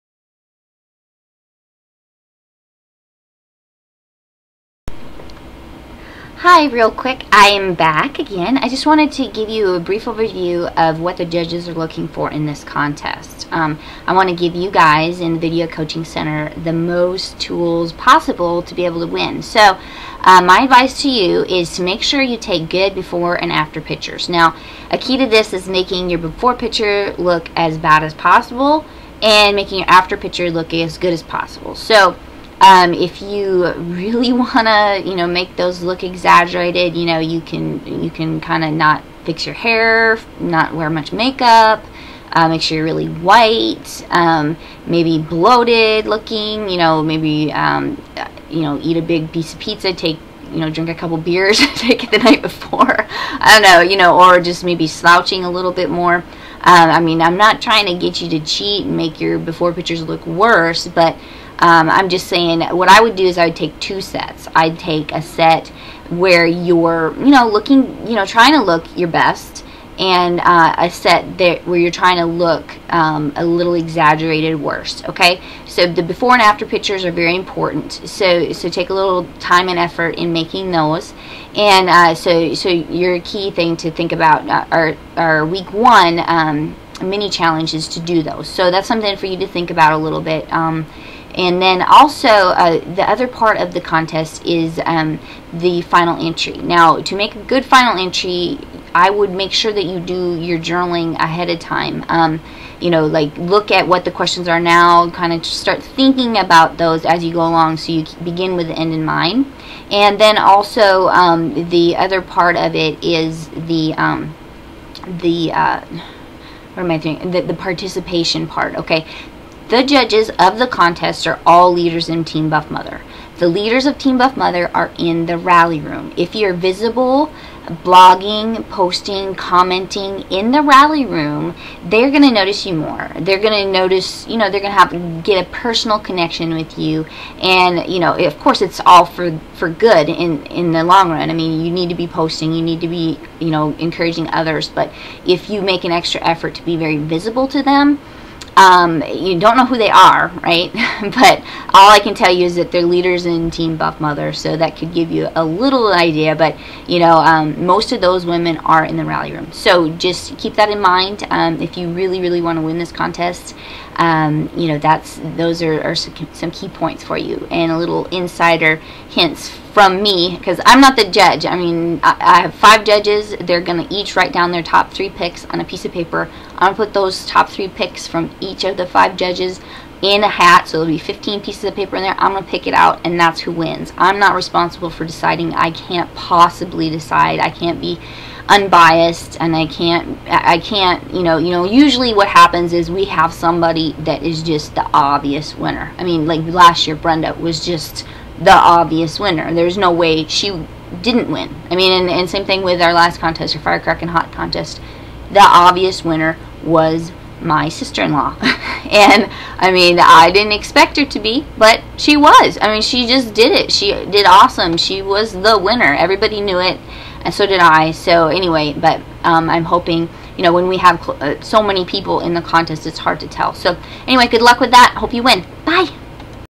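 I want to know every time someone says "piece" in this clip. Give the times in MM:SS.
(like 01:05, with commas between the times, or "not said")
00:49, 02:55, 03:01.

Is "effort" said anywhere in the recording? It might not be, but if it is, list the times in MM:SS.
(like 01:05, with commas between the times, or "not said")
01:19, 02:26.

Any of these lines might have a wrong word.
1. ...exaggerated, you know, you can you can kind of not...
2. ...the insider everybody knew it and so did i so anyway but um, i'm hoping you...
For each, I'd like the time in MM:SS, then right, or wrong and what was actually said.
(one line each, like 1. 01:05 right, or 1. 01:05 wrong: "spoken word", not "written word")
1. 00:36 right
2. 03:35 wrong: "winner", not "insider".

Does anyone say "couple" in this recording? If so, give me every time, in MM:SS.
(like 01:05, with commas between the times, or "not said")
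00:50.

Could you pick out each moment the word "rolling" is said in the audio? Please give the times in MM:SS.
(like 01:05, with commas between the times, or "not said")
not said.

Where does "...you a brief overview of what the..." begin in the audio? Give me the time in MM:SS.
00:09.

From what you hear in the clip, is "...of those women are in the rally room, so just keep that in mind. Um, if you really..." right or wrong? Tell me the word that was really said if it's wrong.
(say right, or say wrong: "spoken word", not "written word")
right.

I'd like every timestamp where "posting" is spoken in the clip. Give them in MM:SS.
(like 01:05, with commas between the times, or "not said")
02:08, 02:22.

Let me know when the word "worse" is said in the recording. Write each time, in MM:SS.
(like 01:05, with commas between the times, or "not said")
01:00, 01:14.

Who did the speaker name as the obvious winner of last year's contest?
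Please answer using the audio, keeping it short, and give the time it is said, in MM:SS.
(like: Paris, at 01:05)
Brenda, at 03:16.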